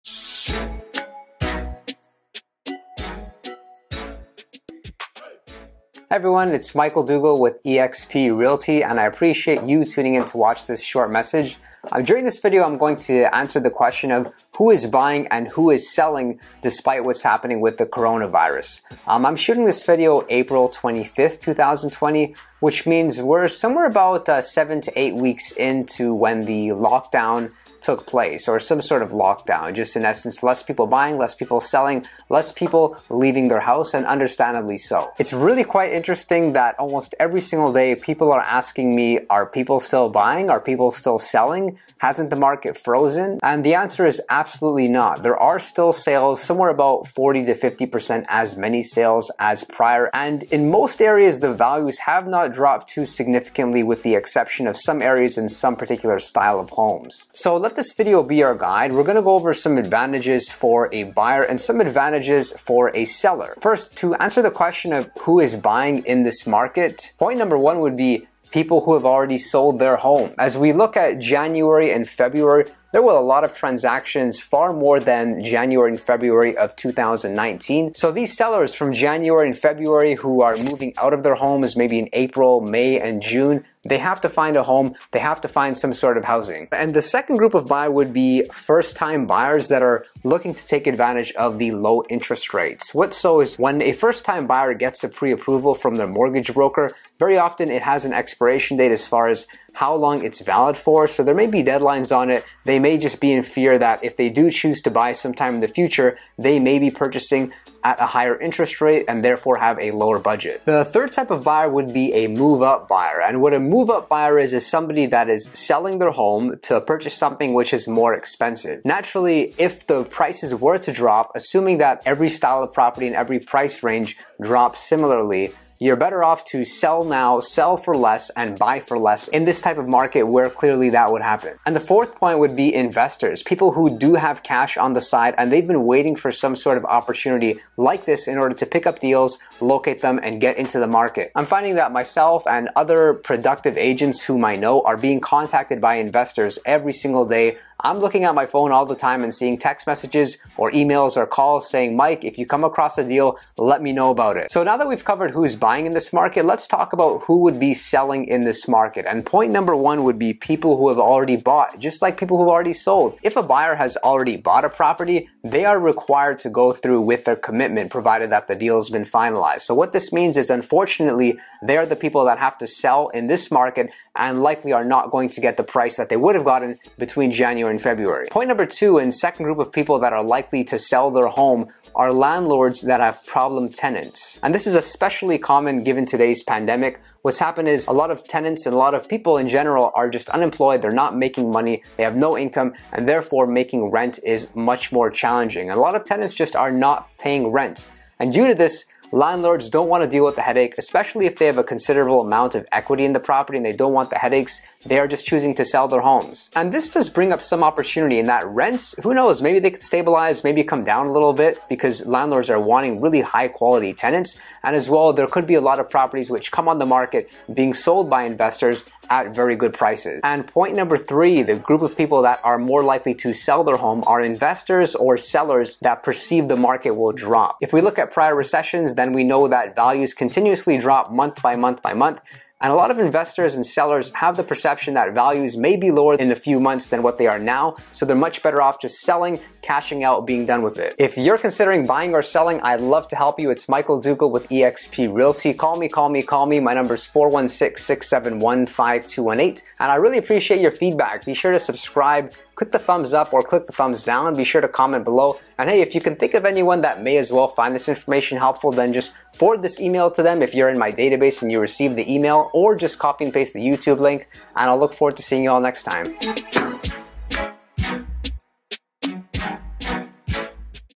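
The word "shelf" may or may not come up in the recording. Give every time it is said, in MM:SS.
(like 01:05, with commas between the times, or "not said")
not said.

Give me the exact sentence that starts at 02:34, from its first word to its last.
So now that we've covered who's buying in this market, let's talk about who would be selling in this market.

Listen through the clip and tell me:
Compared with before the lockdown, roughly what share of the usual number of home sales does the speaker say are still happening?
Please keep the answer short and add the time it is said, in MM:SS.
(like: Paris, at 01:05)
40 to 50%, at 00:47.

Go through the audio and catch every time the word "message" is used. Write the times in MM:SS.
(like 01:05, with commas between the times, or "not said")
00:11, 02:29.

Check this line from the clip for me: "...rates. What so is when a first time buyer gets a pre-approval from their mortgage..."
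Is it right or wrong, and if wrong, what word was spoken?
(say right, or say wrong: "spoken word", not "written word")
right.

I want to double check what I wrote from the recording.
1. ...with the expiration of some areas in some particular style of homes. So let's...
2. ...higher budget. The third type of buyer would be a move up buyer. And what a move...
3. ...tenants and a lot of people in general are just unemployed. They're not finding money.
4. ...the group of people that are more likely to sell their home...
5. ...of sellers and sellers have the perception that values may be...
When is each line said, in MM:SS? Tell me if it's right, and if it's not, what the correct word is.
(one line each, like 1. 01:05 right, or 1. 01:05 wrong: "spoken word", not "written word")
1. 00:53 wrong: "exception", not "expiration"
2. 01:49 wrong: "lower", not "higher"
3. 03:08 wrong: "making", not "finding"
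4. 03:41 right
5. 03:52 wrong: "investors", not "sellers".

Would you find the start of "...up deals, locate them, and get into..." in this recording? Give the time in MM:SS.
02:18.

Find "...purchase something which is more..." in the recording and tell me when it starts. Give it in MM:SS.
01:56.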